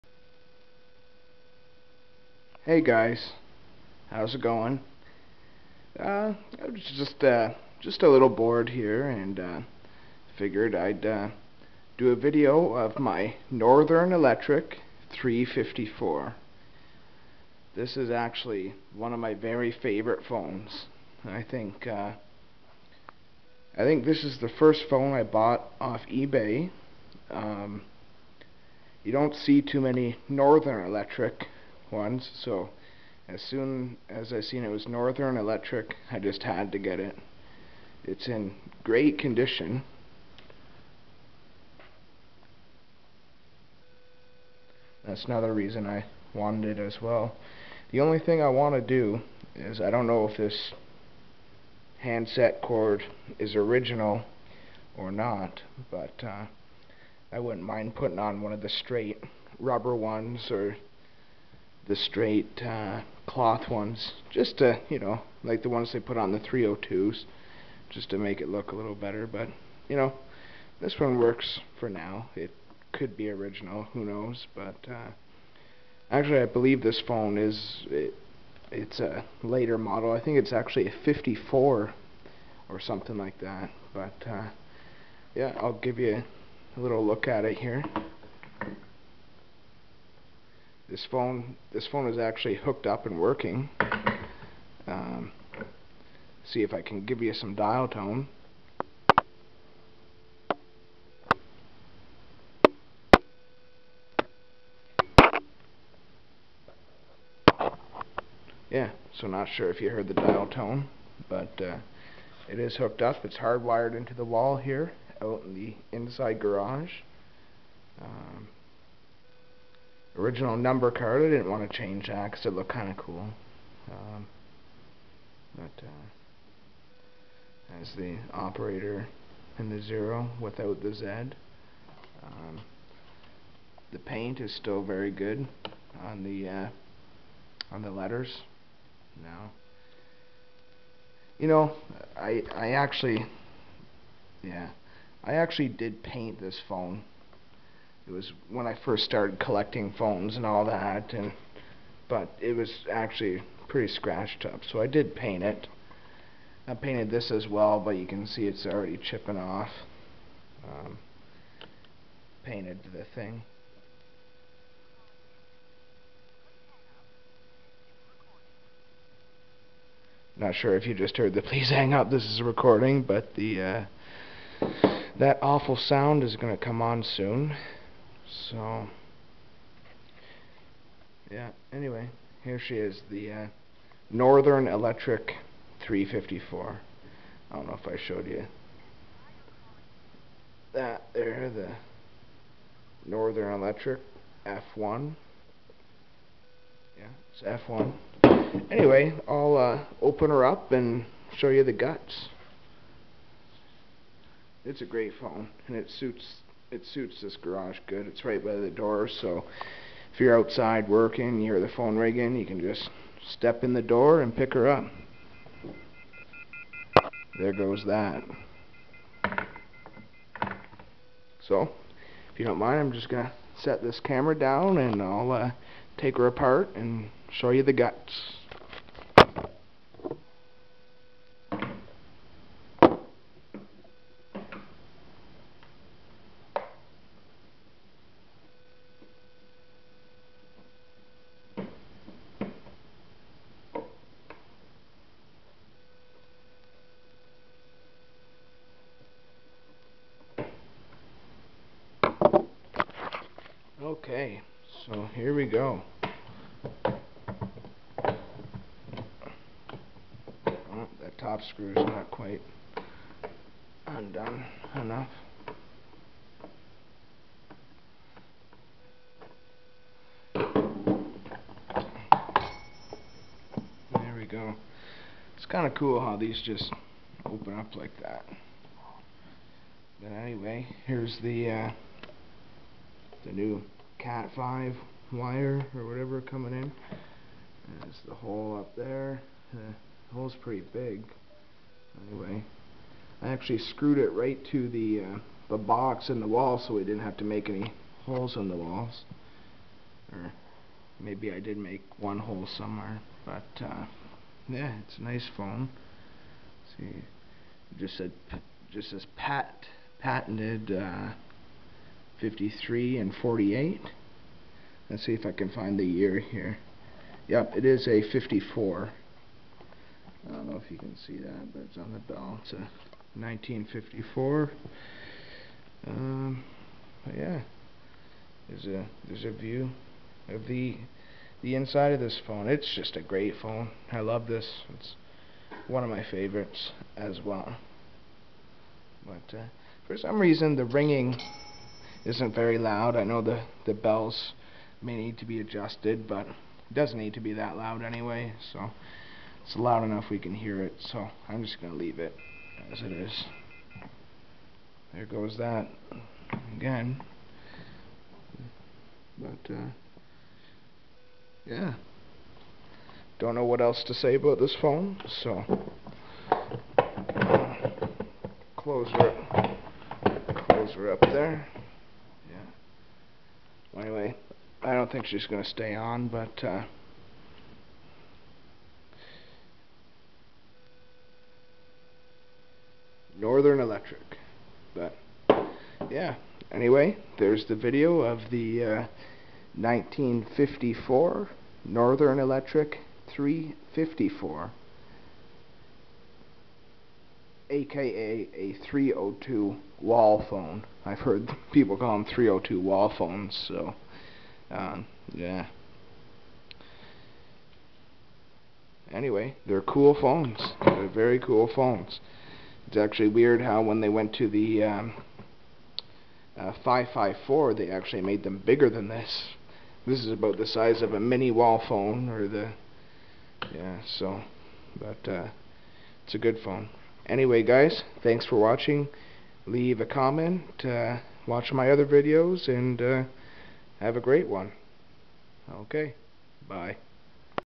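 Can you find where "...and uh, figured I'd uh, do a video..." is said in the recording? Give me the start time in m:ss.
0:09.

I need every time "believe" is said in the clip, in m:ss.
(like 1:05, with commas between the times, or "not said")
1:16.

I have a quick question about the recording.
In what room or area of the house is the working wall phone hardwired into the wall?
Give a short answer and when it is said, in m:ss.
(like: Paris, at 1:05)
inside garage, at 1:55.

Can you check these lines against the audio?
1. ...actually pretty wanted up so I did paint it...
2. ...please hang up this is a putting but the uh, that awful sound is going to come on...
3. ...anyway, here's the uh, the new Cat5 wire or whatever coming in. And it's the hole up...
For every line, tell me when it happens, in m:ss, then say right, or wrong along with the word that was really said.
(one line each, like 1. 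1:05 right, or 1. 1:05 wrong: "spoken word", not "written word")
1. 2:32 wrong: "scratched", not "wanted"
2. 2:51 wrong: "recording", not "putting"
3. 4:40 right.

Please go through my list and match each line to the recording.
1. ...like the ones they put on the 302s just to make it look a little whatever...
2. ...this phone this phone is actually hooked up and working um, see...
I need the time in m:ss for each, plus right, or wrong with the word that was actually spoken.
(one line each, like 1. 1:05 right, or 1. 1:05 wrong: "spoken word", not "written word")
1. 1:05 wrong: "better", not "whatever"
2. 1:30 right.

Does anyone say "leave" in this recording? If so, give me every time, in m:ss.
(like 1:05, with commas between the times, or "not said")
5:51, 7:09.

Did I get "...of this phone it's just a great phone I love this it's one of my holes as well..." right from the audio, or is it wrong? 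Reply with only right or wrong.
wrong.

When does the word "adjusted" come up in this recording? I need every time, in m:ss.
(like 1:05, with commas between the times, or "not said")
5:45.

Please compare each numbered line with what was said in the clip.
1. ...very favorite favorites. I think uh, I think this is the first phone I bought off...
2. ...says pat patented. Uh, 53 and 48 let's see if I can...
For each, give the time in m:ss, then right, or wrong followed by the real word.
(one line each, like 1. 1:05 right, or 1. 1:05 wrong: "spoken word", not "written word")
1. 0:19 wrong: "phones", not "favorites"
2. 5:08 right.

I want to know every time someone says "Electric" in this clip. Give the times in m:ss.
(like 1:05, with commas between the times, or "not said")
0:14, 0:30, 0:35, 3:04, 3:13, 6:23, 6:32.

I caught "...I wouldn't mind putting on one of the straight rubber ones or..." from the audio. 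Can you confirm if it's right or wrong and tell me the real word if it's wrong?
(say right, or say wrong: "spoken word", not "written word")
right.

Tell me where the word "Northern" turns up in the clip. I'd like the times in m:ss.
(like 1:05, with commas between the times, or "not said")
0:13, 0:30, 0:34, 3:04, 3:13, 6:23, 6:31.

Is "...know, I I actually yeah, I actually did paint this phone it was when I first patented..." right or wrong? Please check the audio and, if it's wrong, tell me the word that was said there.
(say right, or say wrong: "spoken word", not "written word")
wrong: "started", not "patented".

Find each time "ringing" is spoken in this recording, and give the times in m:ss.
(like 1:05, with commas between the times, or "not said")
3:31, 5:40.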